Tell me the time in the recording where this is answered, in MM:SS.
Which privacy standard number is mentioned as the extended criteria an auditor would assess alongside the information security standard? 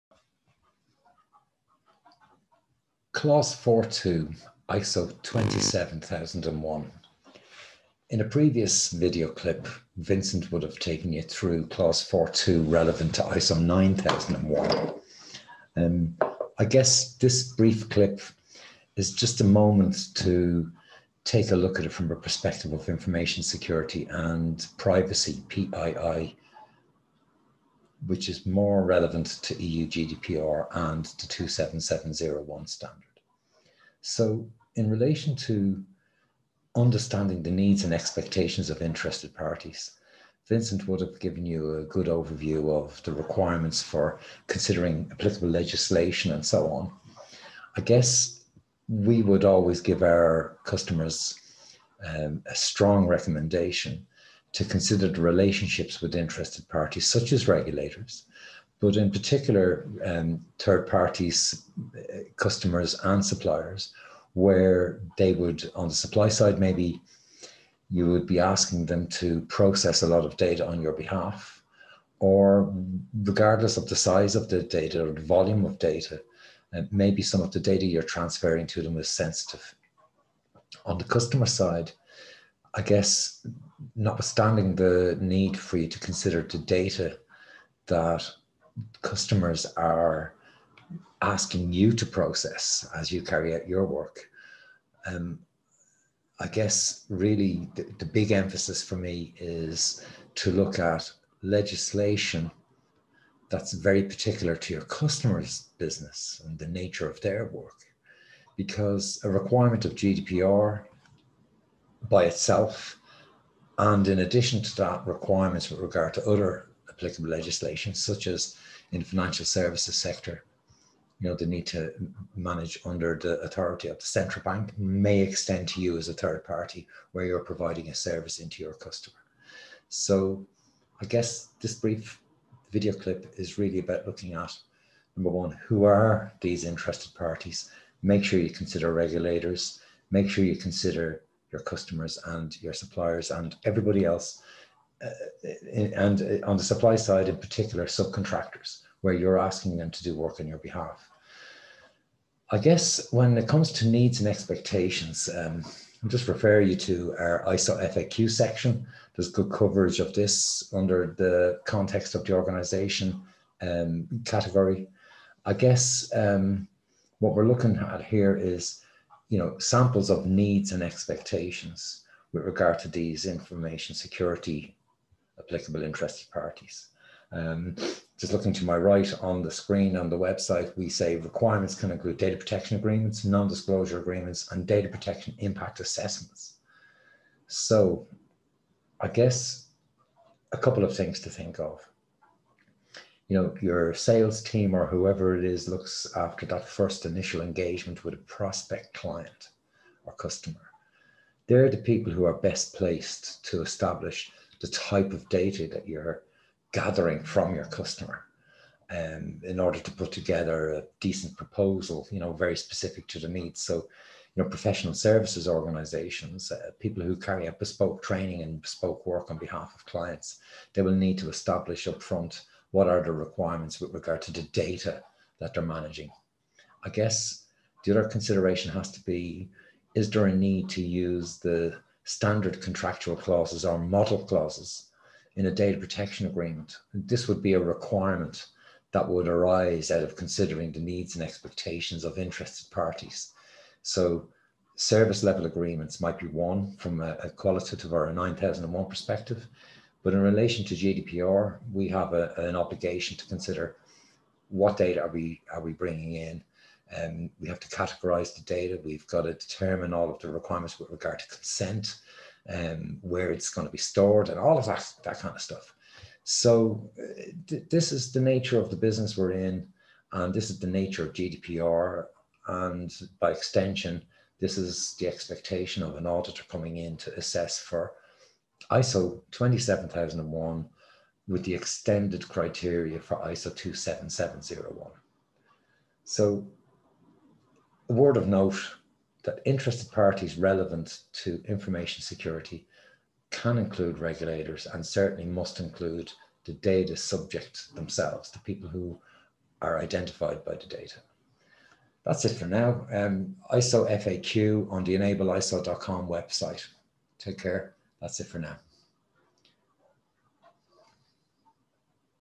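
04:43.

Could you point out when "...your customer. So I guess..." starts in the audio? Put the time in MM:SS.
02:08.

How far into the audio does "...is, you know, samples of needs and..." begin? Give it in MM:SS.
02:48.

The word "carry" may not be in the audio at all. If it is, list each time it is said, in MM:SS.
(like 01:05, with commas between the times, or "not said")
01:33, 03:37.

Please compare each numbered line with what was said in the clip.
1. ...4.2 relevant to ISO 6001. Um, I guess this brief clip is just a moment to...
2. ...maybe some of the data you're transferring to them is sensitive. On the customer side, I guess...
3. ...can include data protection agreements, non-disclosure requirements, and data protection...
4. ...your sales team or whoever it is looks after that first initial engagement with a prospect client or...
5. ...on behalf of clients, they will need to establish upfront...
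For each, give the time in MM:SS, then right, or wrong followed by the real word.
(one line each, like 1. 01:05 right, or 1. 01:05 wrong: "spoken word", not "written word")
1. 00:12 wrong: "9001", not "6001"
2. 01:16 right
3. 03:01 wrong: "agreements", not "requirements"
4. 03:13 right
5. 03:39 right.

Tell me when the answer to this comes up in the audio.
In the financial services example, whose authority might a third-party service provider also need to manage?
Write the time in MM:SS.
02:03.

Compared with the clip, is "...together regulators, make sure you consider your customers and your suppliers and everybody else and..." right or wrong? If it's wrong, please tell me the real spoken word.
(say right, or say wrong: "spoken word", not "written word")
wrong: "consider", not "together".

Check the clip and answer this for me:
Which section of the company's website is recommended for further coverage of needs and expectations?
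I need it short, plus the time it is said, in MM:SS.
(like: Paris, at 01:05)
ISO FAQ section, at 02:37.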